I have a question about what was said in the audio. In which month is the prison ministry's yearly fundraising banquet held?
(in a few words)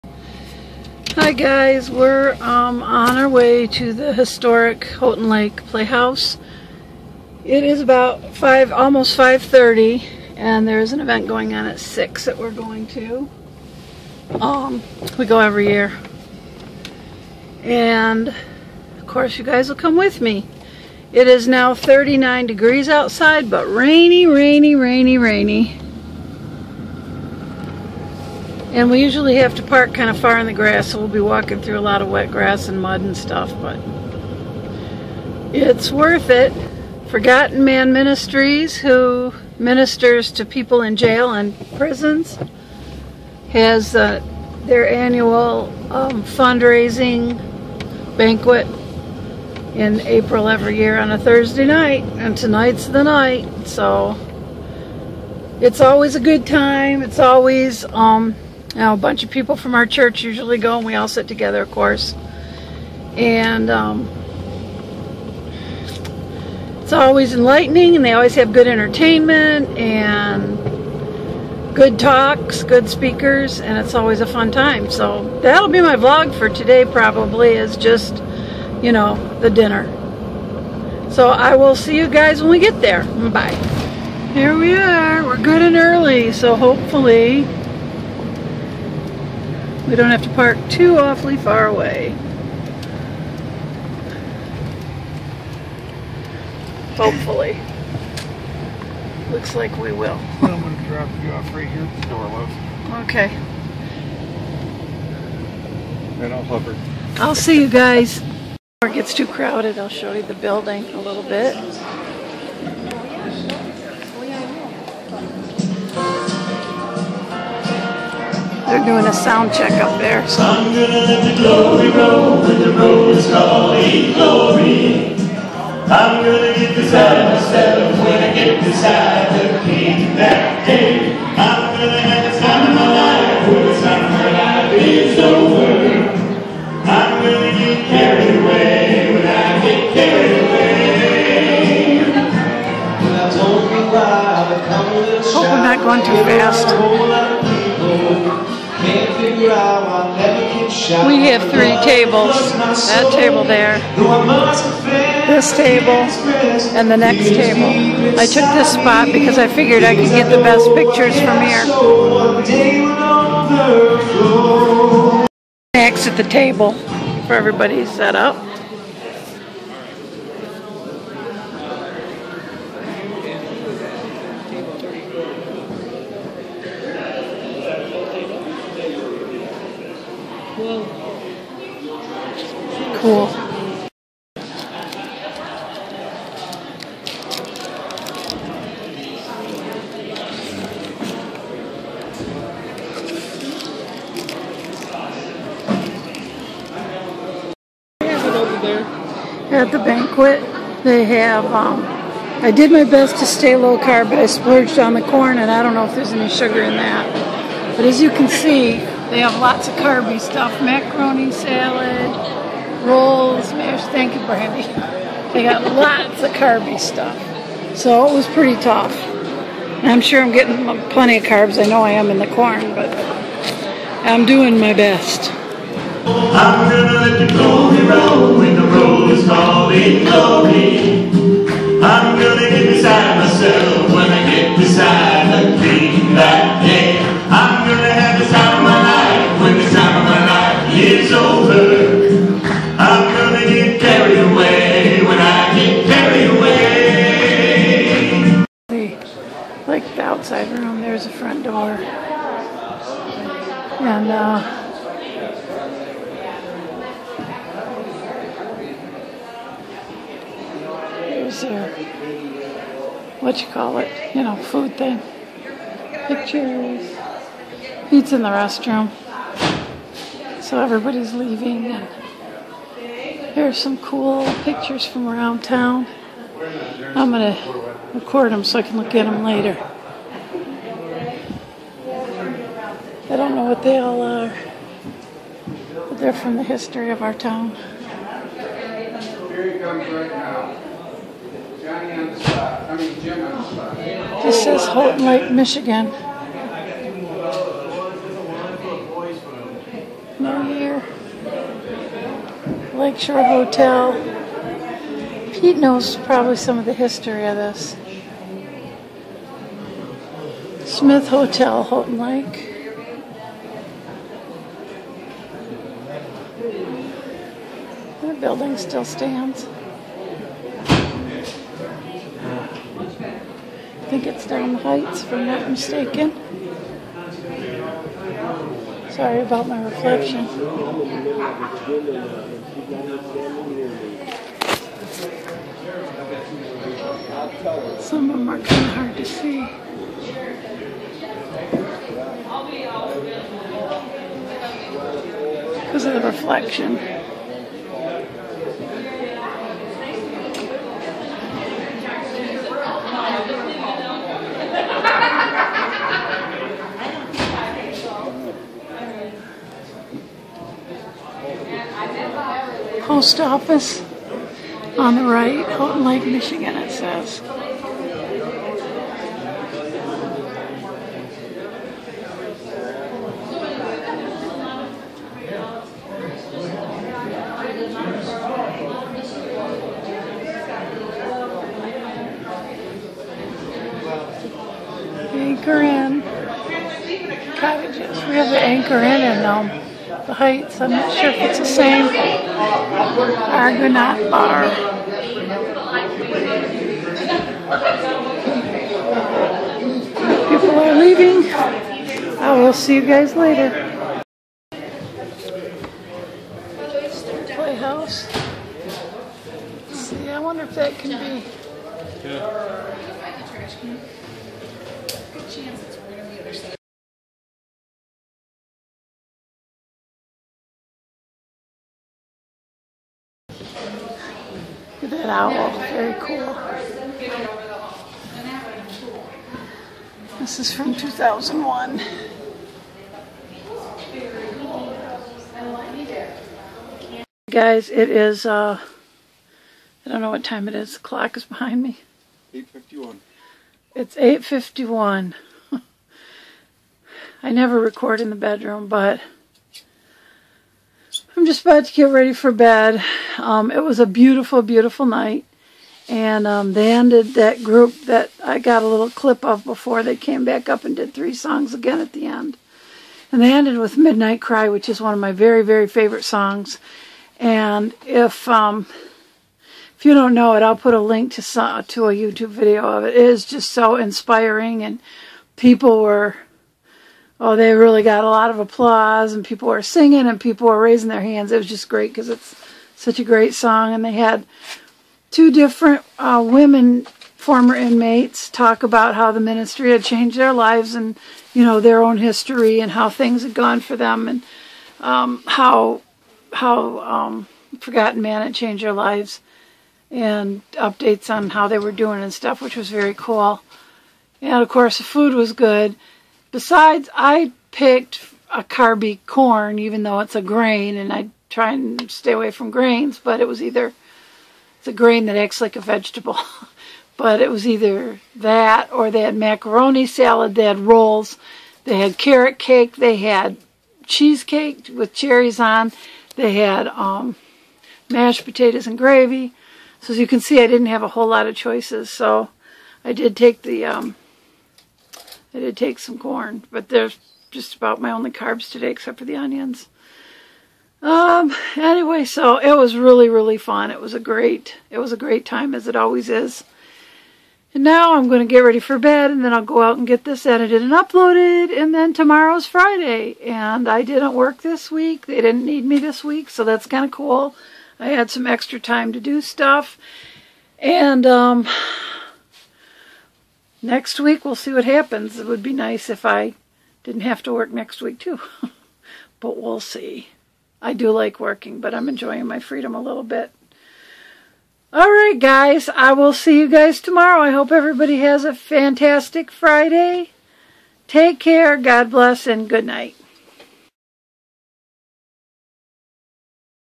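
April.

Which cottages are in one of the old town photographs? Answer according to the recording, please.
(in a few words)
Anchor Inn cottages.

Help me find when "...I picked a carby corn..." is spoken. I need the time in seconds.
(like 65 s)
506 s.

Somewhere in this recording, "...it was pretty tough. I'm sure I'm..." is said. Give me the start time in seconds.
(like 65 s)
218 s.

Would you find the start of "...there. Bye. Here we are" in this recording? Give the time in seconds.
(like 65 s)
82 s.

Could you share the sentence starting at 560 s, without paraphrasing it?
And, um, next week we'll see what happens.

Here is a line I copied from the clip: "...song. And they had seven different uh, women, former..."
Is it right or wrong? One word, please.
wrong.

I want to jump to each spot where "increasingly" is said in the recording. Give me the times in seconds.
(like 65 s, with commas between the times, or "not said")
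not said.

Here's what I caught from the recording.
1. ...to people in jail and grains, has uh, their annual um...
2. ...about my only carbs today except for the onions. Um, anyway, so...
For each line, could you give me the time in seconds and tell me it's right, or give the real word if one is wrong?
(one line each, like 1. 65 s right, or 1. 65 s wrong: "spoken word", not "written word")
1. 40 s wrong: "prisons", not "grains"
2. 537 s right.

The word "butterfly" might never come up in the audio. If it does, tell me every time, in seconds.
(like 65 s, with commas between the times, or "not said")
not said.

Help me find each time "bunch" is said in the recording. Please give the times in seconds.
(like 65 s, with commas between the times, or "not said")
58 s.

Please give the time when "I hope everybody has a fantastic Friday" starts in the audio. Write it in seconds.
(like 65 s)
577 s.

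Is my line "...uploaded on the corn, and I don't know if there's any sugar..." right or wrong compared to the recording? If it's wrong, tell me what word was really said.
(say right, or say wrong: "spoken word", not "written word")
wrong: "splurged", not "uploaded".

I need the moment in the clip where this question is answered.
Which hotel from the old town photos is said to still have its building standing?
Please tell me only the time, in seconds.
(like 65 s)
310 s.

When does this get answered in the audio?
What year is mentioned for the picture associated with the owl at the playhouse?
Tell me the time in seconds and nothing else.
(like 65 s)
430 s.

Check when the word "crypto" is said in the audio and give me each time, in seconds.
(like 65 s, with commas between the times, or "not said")
not said.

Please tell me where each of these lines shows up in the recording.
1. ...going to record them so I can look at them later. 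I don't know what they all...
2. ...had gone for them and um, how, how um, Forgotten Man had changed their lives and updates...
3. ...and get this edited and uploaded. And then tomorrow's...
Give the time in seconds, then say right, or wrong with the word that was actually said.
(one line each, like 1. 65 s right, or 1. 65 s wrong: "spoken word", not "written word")
1. 277 s right
2. 493 s right
3. 549 s right.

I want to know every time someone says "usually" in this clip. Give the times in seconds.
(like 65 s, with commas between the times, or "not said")
29 s, 60 s.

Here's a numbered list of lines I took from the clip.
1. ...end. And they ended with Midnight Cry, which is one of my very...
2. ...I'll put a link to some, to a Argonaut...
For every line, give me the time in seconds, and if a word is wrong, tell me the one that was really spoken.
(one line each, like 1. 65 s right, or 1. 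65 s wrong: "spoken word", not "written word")
1. 462 s right
2. 470 s wrong: "YouTube", not "Argonaut".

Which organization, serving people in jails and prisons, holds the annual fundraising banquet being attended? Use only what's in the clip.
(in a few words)
Forgotten Man Ministries.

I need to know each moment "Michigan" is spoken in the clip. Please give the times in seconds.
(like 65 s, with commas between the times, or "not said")
295 s, 366 s.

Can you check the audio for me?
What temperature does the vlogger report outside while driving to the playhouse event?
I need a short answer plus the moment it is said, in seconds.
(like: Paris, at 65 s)
39 degrees, at 21 s.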